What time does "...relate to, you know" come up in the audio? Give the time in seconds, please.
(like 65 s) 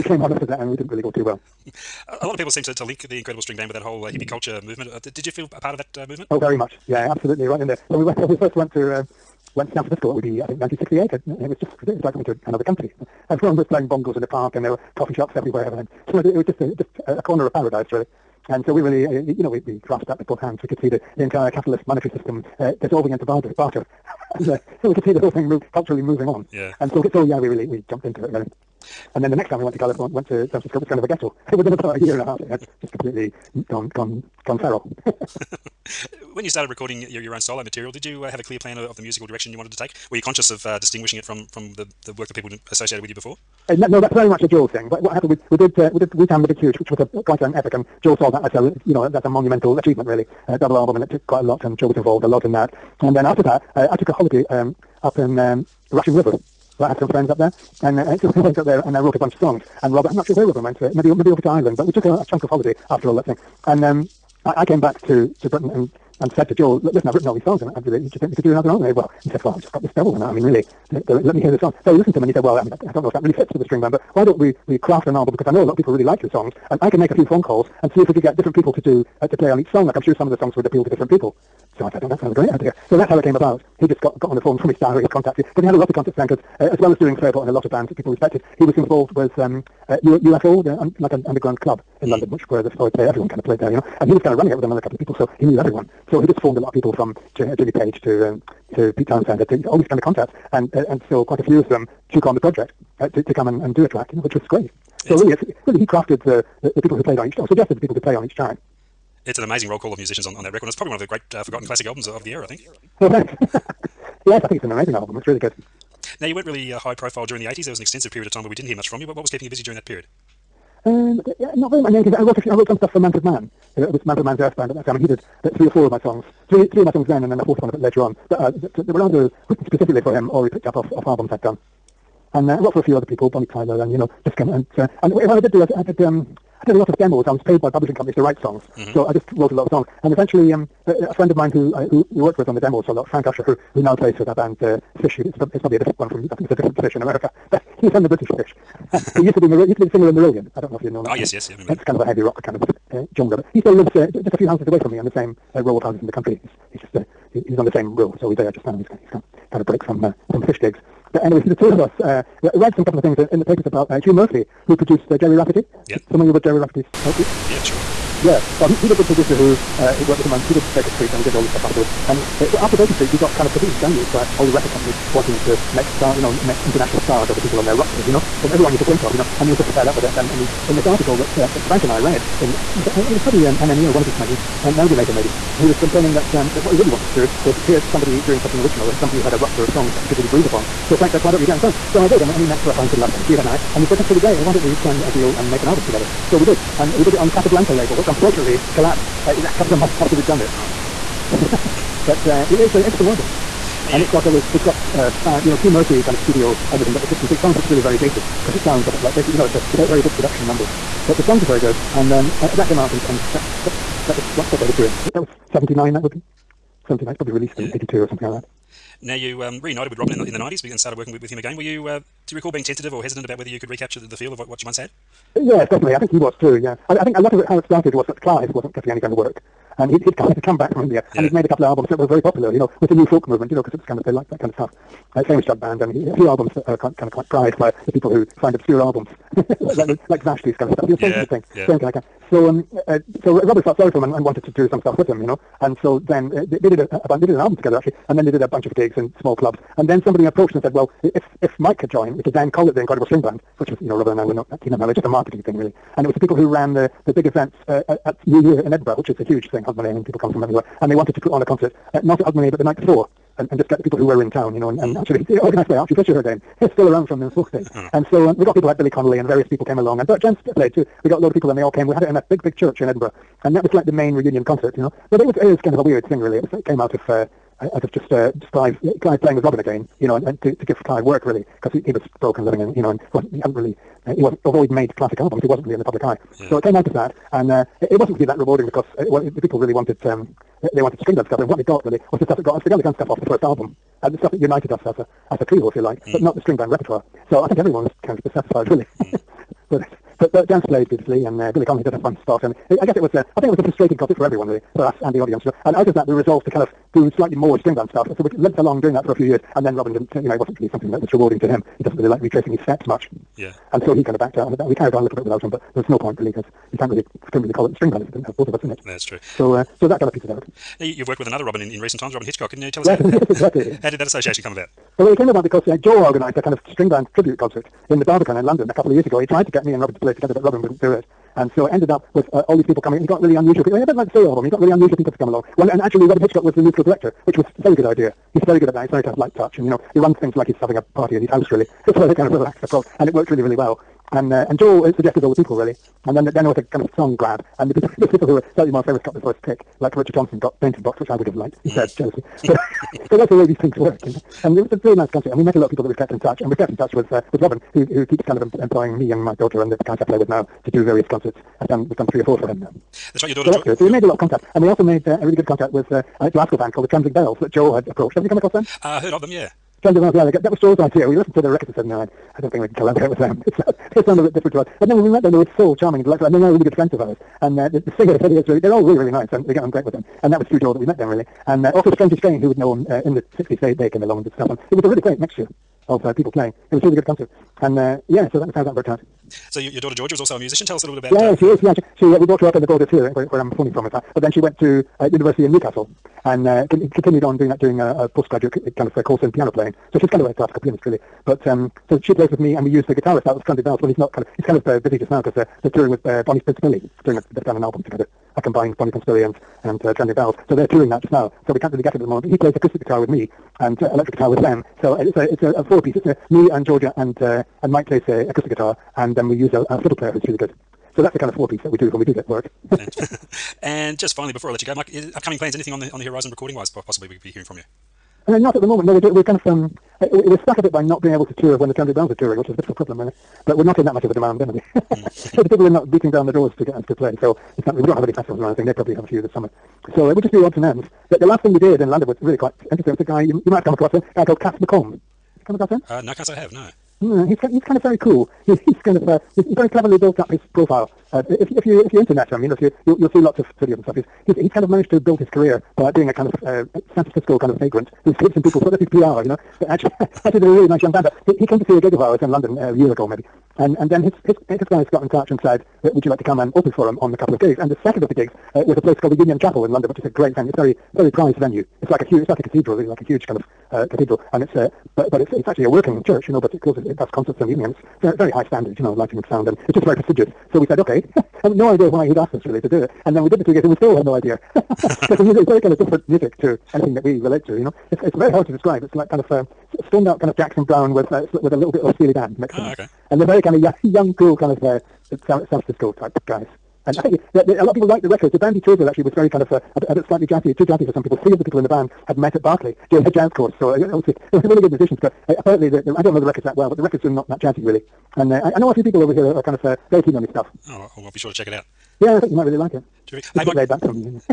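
487 s.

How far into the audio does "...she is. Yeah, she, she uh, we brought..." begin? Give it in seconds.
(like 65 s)
391 s.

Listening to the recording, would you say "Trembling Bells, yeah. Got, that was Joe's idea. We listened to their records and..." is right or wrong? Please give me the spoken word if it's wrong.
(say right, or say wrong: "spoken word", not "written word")
right.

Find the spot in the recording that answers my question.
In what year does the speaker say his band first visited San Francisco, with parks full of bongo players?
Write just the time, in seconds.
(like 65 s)
10 s.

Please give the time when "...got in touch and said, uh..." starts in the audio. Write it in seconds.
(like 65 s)
464 s.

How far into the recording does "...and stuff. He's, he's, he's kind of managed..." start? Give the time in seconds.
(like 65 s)
453 s.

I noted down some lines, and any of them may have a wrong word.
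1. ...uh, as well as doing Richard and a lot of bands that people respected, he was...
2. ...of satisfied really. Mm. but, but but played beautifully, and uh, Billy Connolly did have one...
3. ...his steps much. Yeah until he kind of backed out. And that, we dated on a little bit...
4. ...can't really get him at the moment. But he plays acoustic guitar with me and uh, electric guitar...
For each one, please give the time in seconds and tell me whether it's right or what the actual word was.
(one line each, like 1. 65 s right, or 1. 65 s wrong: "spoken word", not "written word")
1. 86 s wrong: "Fairport", not "Richard"
2. 298 s right
3. 312 s wrong: "carried", not "dated"
4. 411 s right.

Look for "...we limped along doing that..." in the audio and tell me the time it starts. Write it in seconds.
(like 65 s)
308 s.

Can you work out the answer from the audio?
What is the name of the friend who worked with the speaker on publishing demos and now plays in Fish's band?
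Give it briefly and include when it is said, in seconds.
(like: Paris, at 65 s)
Frank Usher, at 143 s.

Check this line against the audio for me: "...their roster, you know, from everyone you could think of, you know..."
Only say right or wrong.
right.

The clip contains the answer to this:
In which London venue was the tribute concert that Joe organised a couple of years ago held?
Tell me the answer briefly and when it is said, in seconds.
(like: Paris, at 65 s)
The Barbican, at 328 s.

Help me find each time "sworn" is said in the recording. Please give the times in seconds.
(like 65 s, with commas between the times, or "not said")
not said.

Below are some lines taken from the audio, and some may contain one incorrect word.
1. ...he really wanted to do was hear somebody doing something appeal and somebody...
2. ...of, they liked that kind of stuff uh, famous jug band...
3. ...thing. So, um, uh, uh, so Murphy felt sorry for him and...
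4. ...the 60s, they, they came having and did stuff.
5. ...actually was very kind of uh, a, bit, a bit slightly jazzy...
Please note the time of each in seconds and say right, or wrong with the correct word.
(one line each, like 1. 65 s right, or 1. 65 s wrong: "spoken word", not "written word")
1. 186 s wrong: "original", not "appeal"
2. 233 s right
3. 241 s wrong: "Robert", not "Murphy"
4. 383 s wrong: "along", not "having"
5. 498 s right.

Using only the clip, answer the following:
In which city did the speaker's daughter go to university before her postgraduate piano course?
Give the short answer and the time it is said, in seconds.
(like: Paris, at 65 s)
Newcastle, at 395 s.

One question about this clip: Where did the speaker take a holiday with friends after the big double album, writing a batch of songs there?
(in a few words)
Russian River.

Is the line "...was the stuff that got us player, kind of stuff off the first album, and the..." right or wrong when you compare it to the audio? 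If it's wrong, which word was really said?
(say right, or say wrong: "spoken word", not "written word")
wrong: "together", not "player".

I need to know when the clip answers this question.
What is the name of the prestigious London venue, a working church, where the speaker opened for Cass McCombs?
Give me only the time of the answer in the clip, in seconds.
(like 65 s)
469 s.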